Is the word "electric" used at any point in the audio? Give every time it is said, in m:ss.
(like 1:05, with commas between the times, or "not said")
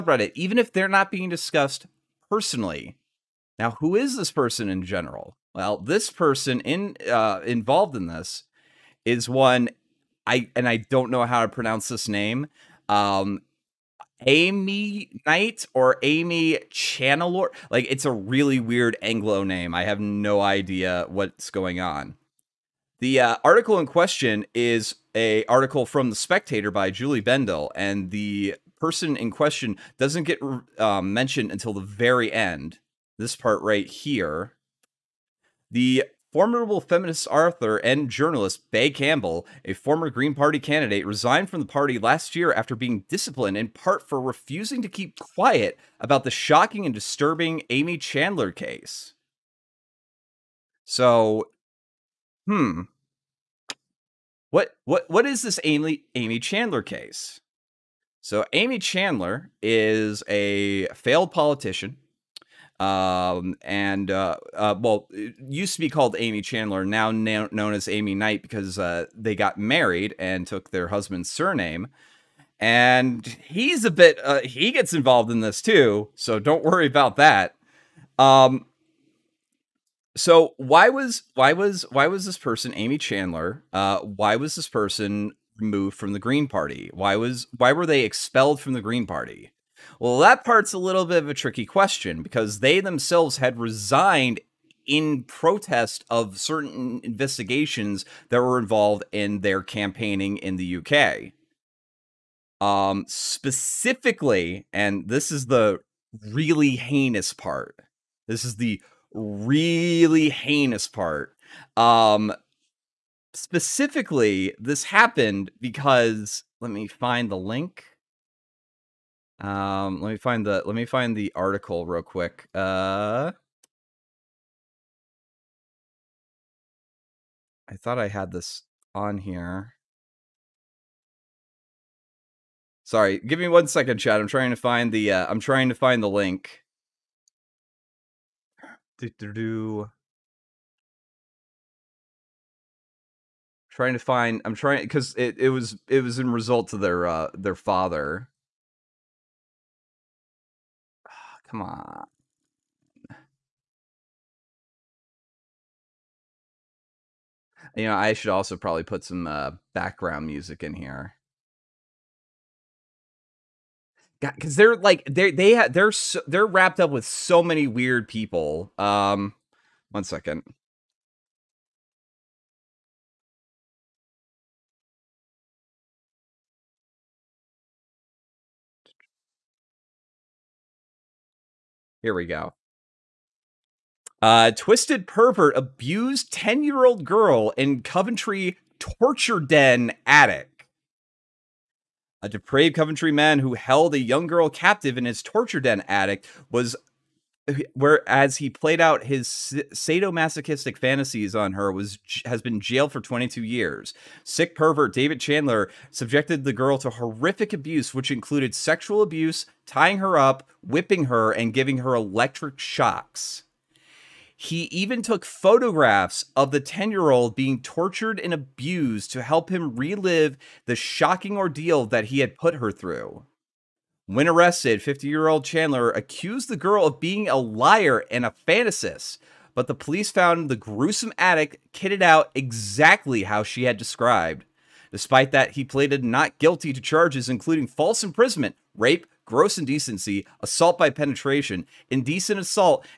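3:31.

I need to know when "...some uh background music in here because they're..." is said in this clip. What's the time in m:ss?
2:39.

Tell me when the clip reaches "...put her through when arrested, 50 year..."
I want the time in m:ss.
3:42.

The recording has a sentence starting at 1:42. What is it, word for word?
Um, specifically, and this is the really heinous part.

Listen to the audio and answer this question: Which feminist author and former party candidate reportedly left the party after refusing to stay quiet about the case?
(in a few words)
Bea Campbell.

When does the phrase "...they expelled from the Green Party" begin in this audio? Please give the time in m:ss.
1:27.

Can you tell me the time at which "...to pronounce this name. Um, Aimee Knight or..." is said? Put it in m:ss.
0:11.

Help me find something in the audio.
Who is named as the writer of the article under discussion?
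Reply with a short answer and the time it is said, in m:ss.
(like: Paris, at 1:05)
Julie Bindel, at 0:26.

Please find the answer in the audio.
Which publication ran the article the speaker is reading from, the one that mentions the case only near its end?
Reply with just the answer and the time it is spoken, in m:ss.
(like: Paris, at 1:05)
The Spectator, at 0:26.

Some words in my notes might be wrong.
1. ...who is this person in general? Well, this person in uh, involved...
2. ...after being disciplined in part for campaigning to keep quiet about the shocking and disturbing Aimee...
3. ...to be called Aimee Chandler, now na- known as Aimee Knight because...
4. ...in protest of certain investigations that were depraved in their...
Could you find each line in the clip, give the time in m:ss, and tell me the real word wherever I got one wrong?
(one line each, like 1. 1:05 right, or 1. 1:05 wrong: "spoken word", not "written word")
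1. 0:03 right
2. 0:42 wrong: "refusing", not "campaigning"
3. 1:05 right
4. 1:34 wrong: "involved", not "depraved".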